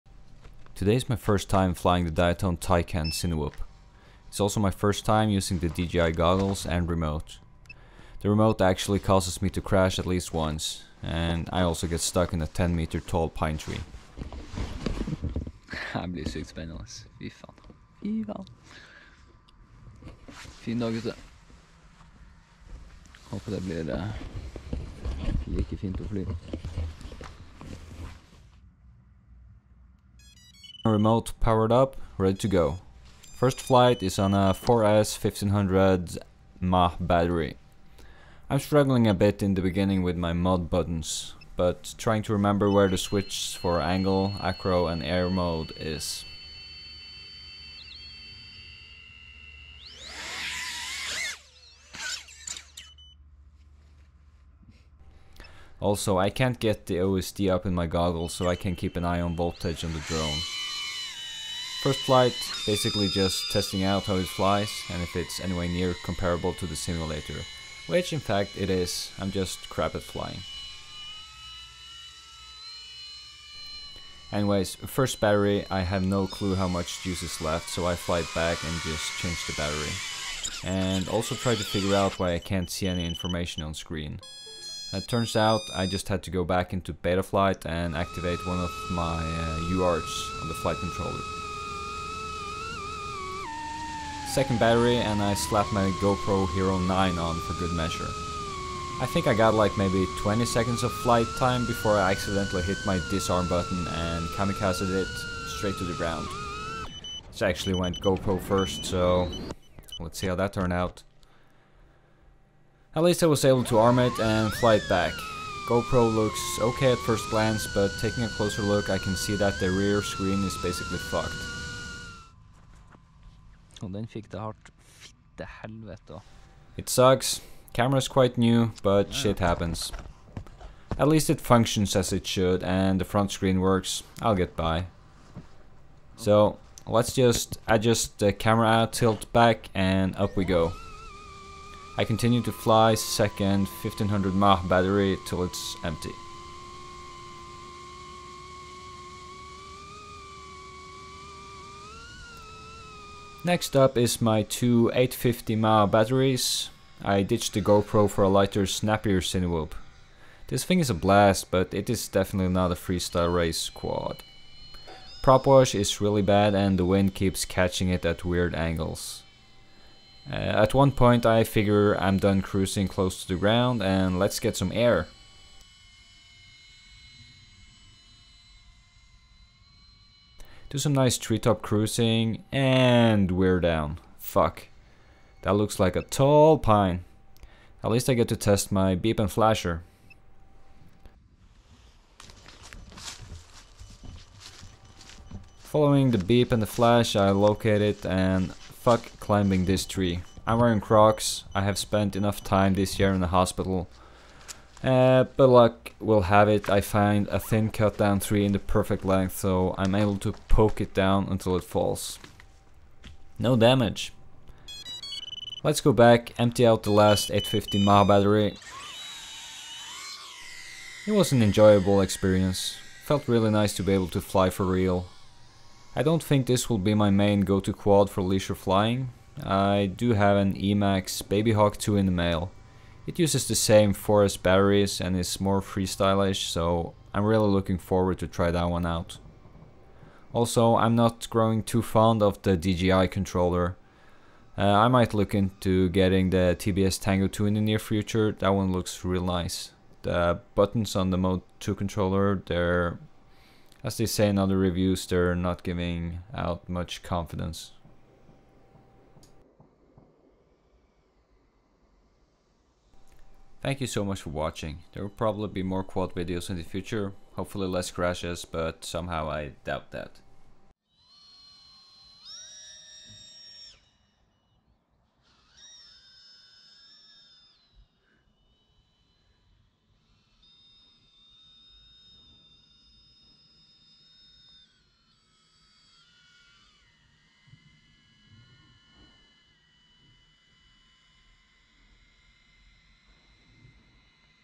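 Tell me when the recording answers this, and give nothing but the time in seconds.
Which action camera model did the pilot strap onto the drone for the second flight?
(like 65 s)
95 s.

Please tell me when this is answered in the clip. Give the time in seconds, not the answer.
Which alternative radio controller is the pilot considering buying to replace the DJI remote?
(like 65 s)
246 s.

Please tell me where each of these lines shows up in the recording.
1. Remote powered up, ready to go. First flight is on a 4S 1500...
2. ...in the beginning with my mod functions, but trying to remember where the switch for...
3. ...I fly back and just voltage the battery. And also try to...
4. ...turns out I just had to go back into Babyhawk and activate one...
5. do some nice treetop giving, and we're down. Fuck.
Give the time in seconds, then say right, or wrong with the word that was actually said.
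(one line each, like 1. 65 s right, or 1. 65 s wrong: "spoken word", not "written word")
1. 30 s right
2. 39 s wrong: "buttons", not "functions"
3. 77 s wrong: "change", not "voltage"
4. 85 s wrong: "Betaflight", not "Babyhawk"
5. 180 s wrong: "cruising", not "giving".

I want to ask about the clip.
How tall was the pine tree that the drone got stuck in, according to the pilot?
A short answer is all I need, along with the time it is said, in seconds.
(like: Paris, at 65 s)
10 meters, at 12 s.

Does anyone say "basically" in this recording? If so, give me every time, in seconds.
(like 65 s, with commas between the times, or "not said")
62 s, 120 s.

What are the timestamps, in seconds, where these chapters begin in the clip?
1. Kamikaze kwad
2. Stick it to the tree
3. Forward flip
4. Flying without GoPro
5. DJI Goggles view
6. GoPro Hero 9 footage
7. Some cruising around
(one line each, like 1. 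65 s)
1. 102 s
2. 180 s
3. 270 s
4. 153 s
5. 66 s
6. 88 s
7. 218 s.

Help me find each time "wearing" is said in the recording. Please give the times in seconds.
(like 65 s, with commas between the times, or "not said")
200 s.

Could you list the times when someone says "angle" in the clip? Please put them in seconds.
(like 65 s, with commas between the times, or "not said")
43 s, 168 s.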